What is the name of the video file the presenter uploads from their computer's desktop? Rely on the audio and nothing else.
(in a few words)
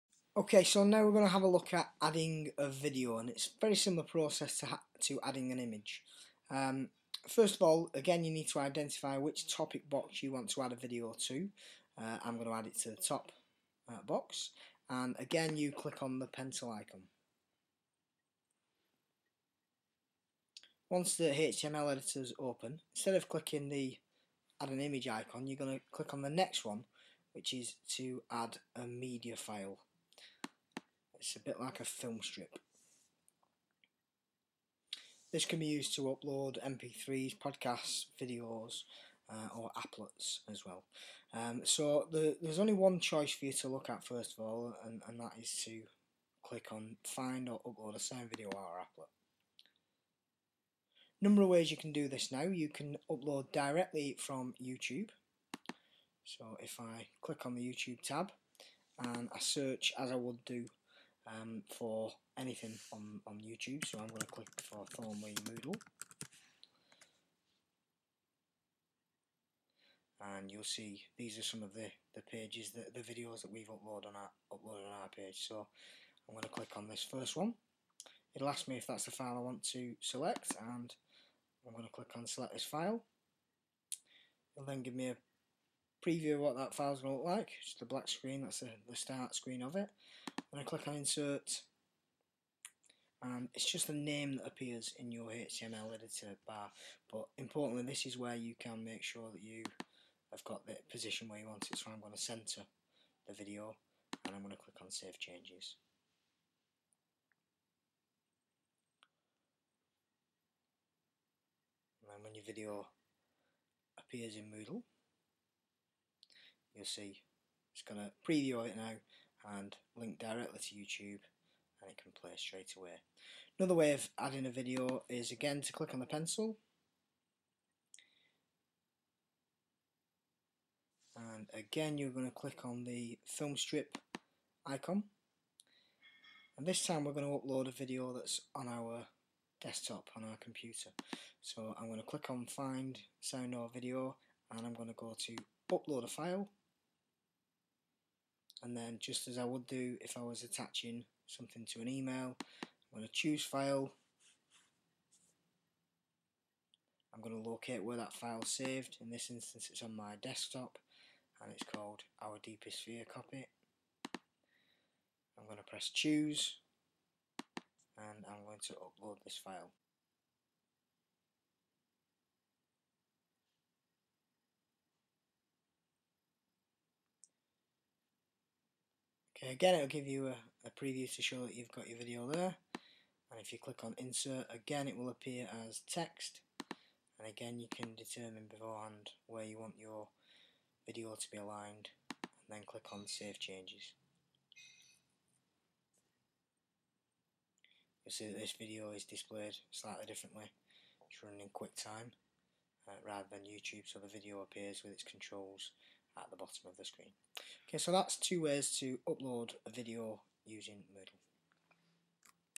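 Our Deepest Fear copy.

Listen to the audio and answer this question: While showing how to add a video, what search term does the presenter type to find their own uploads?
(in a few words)
Thornleigh Moodle.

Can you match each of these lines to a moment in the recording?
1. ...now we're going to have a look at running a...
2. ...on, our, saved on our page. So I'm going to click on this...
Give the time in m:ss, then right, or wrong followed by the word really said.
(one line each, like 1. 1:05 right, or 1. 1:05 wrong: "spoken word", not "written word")
1. 0:00 wrong: "adding", not "running"
2. 1:14 wrong: "uploaded", not "saved".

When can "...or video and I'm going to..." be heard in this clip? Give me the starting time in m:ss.
2:23.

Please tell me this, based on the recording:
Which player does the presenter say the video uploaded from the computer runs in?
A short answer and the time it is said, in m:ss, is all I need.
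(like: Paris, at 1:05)
QuickTime, at 3:21.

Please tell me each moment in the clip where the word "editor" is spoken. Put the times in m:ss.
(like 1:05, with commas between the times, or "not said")
0:21, 1:35.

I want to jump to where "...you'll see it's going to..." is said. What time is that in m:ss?
1:56.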